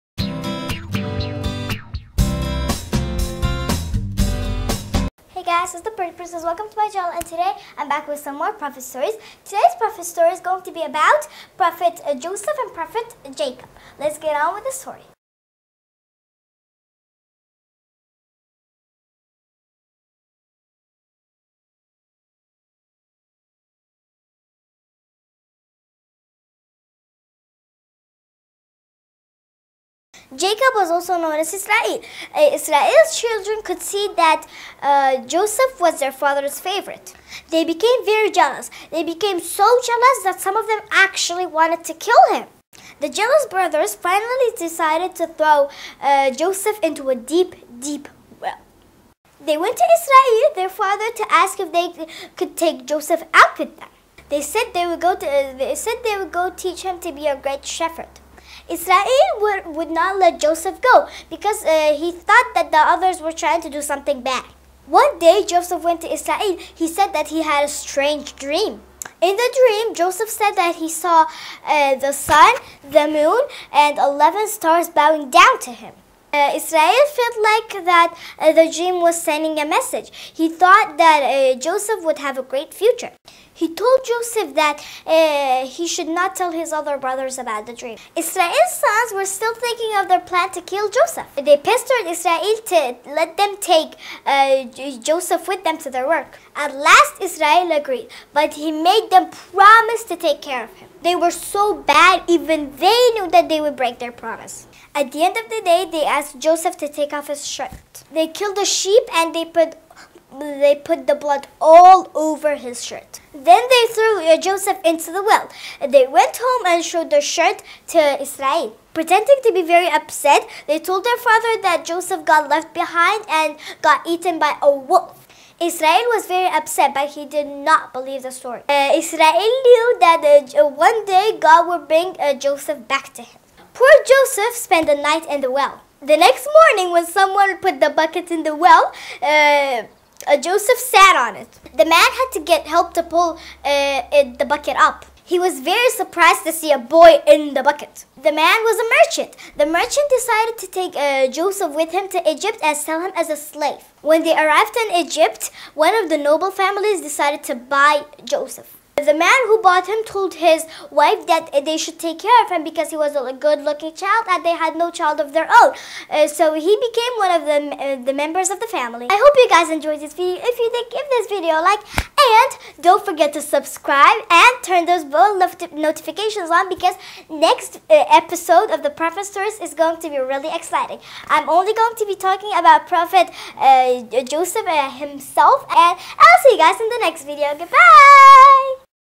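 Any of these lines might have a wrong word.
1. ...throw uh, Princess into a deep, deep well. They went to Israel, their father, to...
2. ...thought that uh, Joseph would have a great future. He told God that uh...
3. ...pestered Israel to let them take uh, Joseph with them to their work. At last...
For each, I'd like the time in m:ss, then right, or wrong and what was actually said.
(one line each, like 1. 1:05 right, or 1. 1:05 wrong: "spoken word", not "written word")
1. 0:45 wrong: "Joseph", not "Princess"
2. 1:20 wrong: "Joseph", not "God"
3. 1:31 right.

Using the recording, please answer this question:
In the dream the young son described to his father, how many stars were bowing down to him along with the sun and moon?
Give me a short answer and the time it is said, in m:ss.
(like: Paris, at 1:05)
11, at 1:13.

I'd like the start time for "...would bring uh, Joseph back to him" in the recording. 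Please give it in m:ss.
2:11.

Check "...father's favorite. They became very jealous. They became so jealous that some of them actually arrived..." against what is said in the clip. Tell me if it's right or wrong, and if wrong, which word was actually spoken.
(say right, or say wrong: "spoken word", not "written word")
wrong: "wanted", not "arrived".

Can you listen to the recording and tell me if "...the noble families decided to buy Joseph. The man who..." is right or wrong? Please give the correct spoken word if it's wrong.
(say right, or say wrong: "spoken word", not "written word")
right.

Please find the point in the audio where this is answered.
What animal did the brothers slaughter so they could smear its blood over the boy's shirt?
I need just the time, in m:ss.
1:48.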